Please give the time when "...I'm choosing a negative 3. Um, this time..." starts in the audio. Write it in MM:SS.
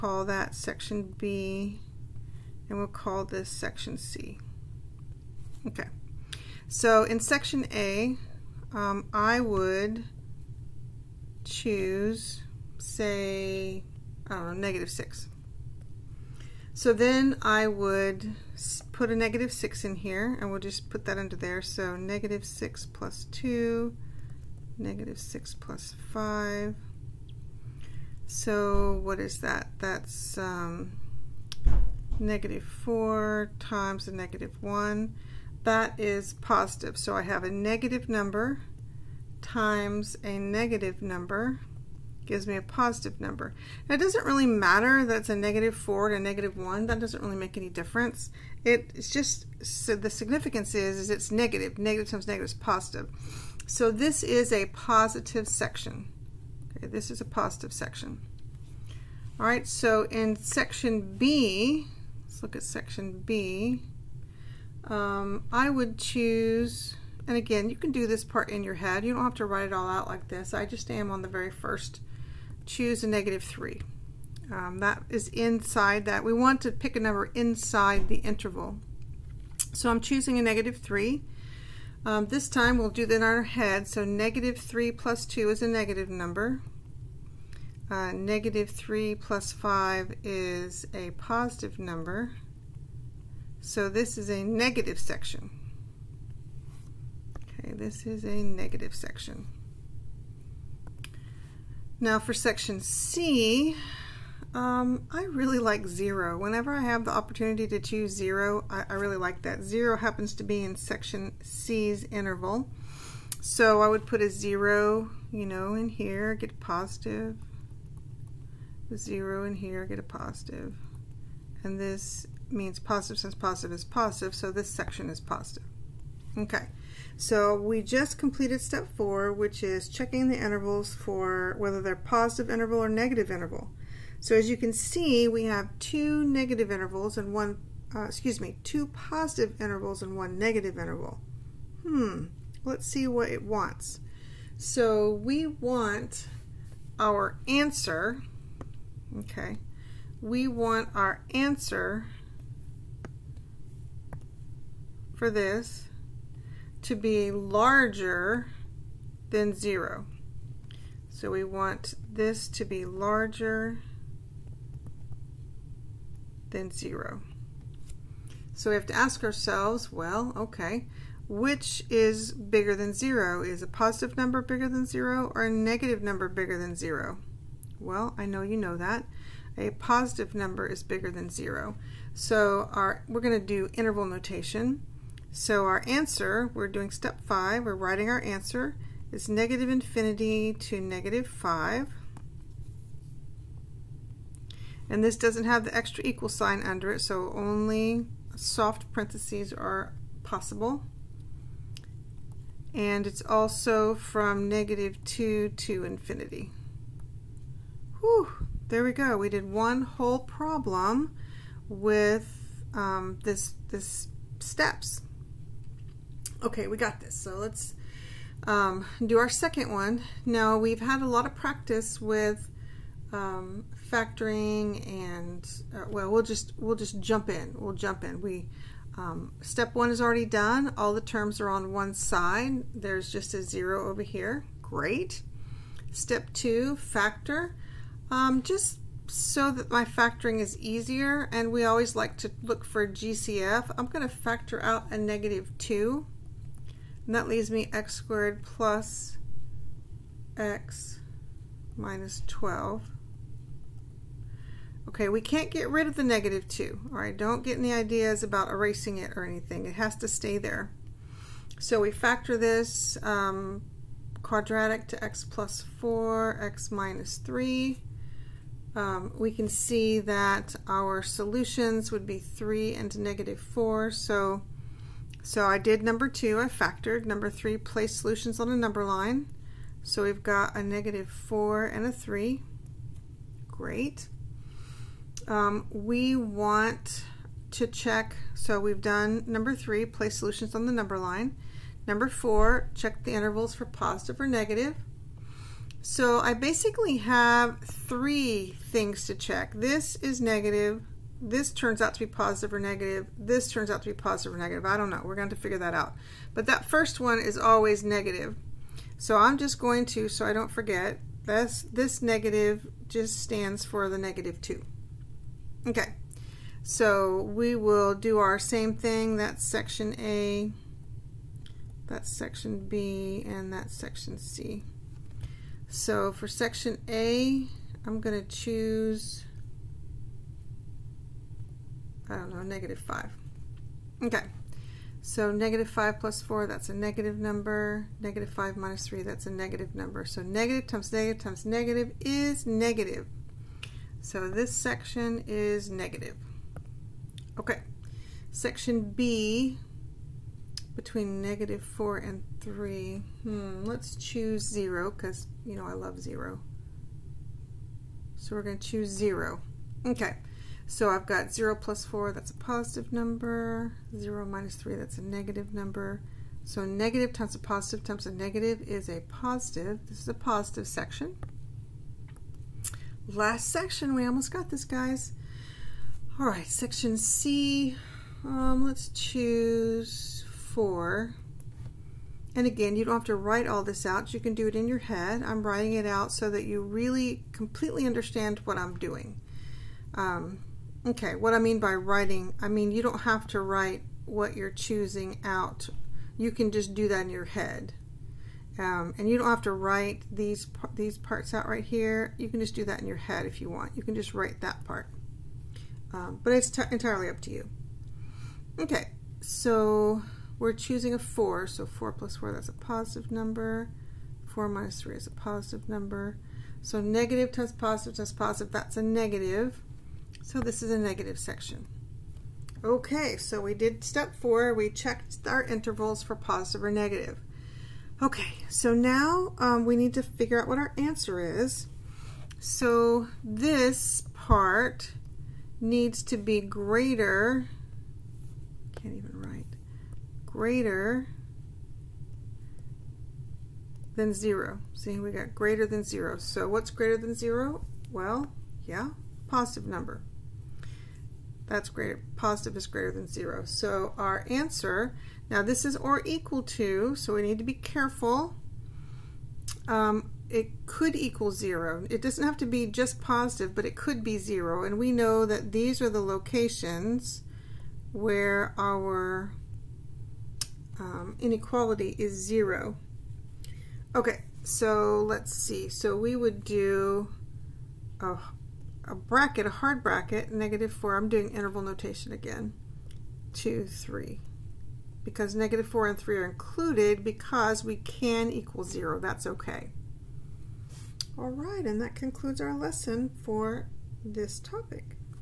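01:19.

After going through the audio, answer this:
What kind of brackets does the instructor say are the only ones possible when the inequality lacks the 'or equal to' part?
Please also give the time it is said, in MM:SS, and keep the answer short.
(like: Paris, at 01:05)
soft parentheses, at 03:18.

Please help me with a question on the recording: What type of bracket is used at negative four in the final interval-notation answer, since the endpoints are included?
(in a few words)
hard bracket.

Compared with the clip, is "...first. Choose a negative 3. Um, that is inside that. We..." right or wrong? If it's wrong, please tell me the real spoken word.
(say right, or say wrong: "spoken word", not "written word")
right.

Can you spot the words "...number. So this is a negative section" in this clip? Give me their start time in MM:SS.
01:31.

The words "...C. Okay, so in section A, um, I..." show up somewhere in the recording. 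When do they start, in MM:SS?
00:03.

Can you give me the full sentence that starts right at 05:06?
But that first one is always negative.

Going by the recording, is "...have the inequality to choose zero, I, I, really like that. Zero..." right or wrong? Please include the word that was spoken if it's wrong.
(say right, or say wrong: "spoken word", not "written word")
wrong: "opportunity", not "inequality".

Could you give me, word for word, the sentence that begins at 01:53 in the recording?
So I would put a zero, you know, in here, get a positive.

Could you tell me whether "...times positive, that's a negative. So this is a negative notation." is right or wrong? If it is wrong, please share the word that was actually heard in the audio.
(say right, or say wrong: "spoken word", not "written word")
wrong: "section", not "notation".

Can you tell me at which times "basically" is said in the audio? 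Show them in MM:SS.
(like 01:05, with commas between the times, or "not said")
04:56.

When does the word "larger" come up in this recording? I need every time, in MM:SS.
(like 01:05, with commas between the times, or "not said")
02:37, 02:42.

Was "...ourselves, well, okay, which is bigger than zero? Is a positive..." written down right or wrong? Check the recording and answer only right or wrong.
right.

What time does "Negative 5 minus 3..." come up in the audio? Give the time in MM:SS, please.
05:37.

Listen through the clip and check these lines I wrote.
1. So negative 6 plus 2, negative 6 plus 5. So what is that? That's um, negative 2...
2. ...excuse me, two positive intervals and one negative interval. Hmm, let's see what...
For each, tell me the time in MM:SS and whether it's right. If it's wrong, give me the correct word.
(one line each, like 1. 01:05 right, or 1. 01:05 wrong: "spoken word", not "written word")
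1. 00:21 wrong: "4", not "2"
2. 02:18 right.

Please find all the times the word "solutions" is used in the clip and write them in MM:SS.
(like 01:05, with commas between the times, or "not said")
04:31, 04:37, 04:50.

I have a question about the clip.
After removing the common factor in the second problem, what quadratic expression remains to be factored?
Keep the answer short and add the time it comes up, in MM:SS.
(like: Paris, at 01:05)
x squared plus x minus 12, at 04:07.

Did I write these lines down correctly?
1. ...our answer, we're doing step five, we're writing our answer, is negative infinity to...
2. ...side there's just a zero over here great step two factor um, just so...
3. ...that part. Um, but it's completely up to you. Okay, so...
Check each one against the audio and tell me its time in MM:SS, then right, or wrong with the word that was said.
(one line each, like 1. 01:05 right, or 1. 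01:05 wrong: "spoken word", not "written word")
1. 03:05 right
2. 03:51 right
3. 06:44 wrong: "entirely", not "completely".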